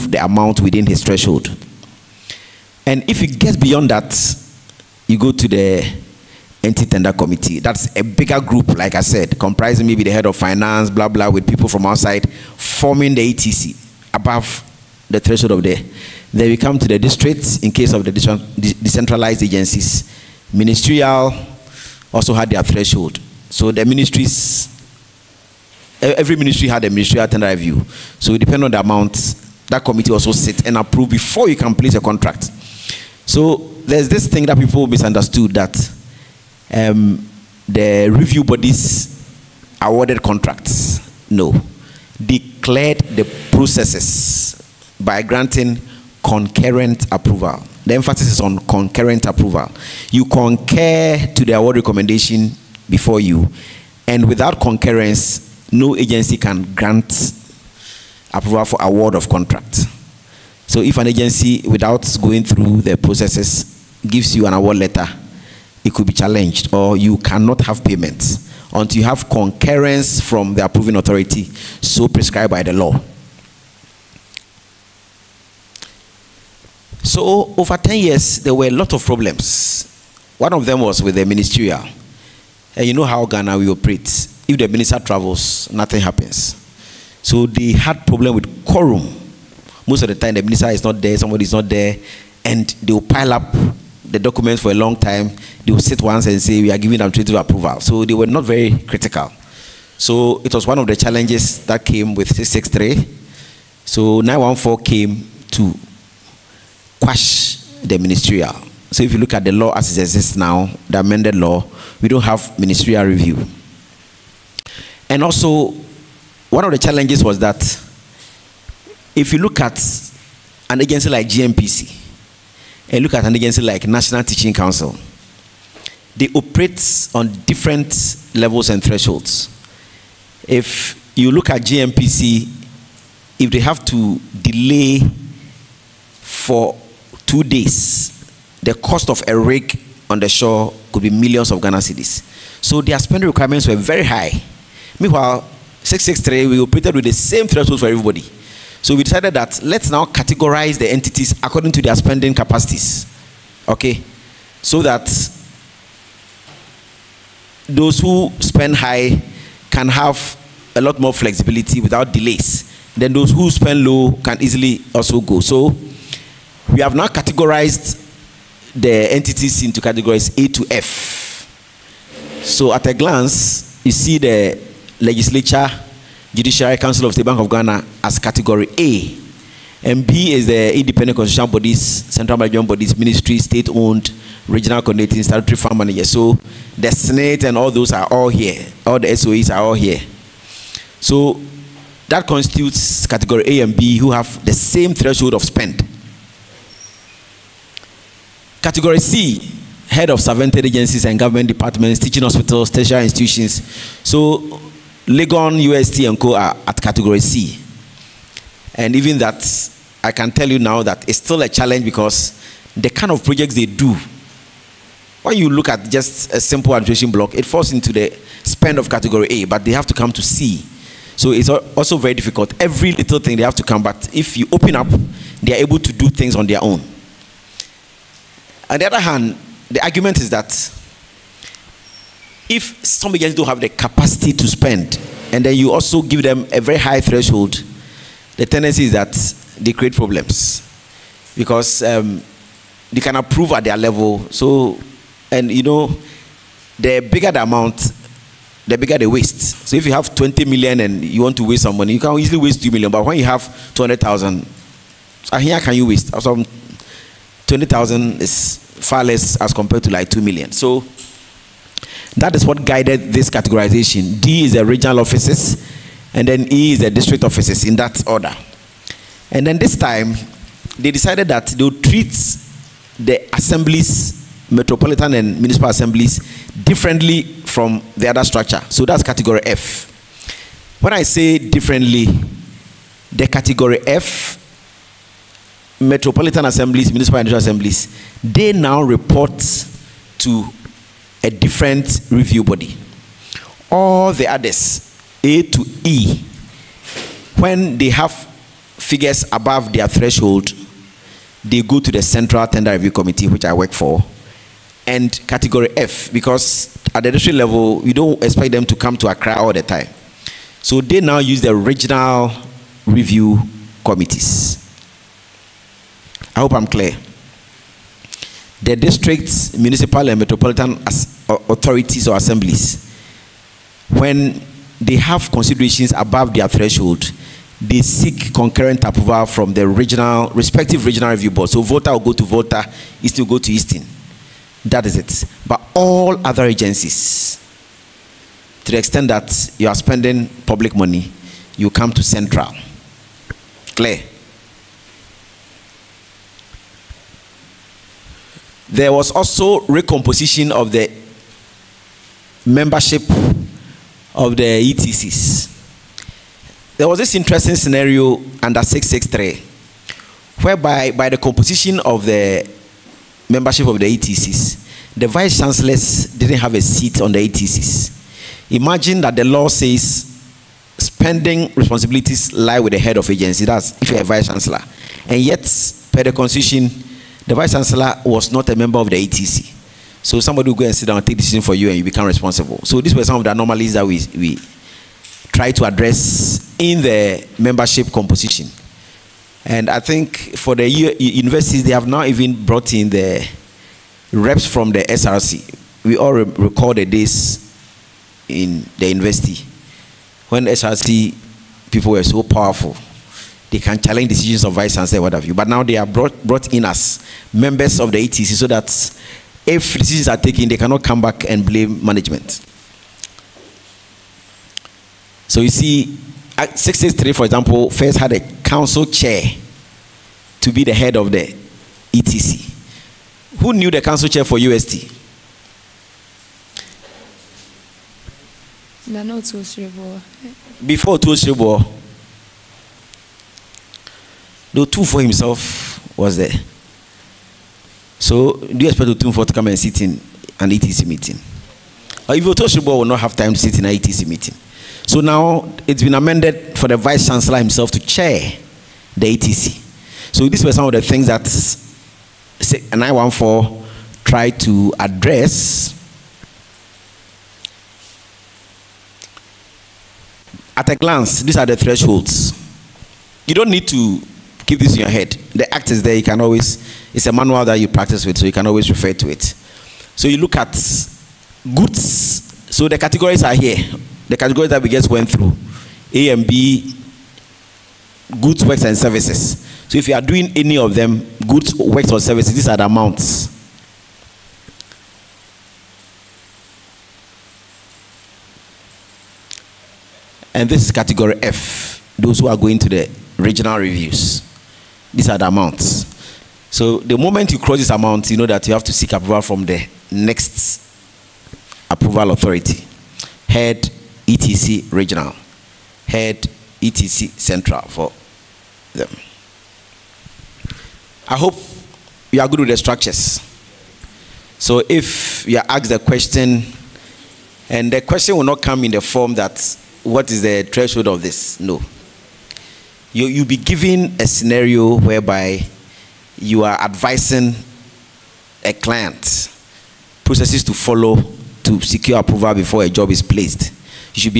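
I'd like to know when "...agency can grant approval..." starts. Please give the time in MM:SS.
00:55.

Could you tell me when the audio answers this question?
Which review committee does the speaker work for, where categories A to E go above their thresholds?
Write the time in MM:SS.
05:02.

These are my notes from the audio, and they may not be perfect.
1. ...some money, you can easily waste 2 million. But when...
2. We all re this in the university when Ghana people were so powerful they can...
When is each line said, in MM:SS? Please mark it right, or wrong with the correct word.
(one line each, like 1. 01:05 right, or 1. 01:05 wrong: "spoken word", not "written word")
1. 04:11 right
2. 06:35 wrong: "SRC", not "Ghana".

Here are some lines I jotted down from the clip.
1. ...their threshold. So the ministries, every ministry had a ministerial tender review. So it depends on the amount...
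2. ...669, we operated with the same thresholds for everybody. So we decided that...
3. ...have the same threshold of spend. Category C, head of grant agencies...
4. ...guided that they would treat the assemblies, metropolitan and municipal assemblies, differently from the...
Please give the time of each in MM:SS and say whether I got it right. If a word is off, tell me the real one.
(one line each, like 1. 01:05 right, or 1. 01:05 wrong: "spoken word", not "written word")
1. 00:22 right
2. 02:25 wrong: "663", not "669"
3. 03:14 wrong: "servant", not "grant"
4. 04:30 wrong: "decided", not "guided".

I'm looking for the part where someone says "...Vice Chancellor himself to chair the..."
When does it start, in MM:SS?
07:26.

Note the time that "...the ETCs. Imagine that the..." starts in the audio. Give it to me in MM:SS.
06:07.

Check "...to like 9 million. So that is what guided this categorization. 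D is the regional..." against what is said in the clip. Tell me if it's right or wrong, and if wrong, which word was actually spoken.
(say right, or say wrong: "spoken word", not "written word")
wrong: "2", not "9".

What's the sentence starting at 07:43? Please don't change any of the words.
You don't need to keep this in your head.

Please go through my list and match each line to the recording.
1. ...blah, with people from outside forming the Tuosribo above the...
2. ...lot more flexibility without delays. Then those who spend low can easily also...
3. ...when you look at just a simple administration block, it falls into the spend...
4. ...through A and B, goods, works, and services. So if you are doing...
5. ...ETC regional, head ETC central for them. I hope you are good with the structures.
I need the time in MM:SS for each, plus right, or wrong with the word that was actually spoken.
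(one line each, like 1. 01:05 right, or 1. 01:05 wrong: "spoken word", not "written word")
1. 00:11 wrong: "ETC", not "Tuosribo"
2. 02:40 right
3. 03:35 right
4. 07:55 right
5. 08:24 right.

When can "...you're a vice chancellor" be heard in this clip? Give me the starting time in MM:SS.
06:13.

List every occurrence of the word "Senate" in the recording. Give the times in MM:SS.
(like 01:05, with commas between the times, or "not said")
03:06.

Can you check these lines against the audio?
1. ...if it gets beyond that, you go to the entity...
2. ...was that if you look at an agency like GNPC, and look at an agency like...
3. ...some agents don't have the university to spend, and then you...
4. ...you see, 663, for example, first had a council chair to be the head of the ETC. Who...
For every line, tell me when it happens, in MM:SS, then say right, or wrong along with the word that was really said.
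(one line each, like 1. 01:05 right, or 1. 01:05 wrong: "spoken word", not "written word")
1. 00:03 right
2. 01:57 right
3. 03:52 wrong: "capacity", not "university"
4. 06:55 right.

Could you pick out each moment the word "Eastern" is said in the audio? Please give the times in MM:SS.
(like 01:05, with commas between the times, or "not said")
05:33.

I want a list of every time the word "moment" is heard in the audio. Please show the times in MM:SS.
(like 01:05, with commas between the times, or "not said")
08:16.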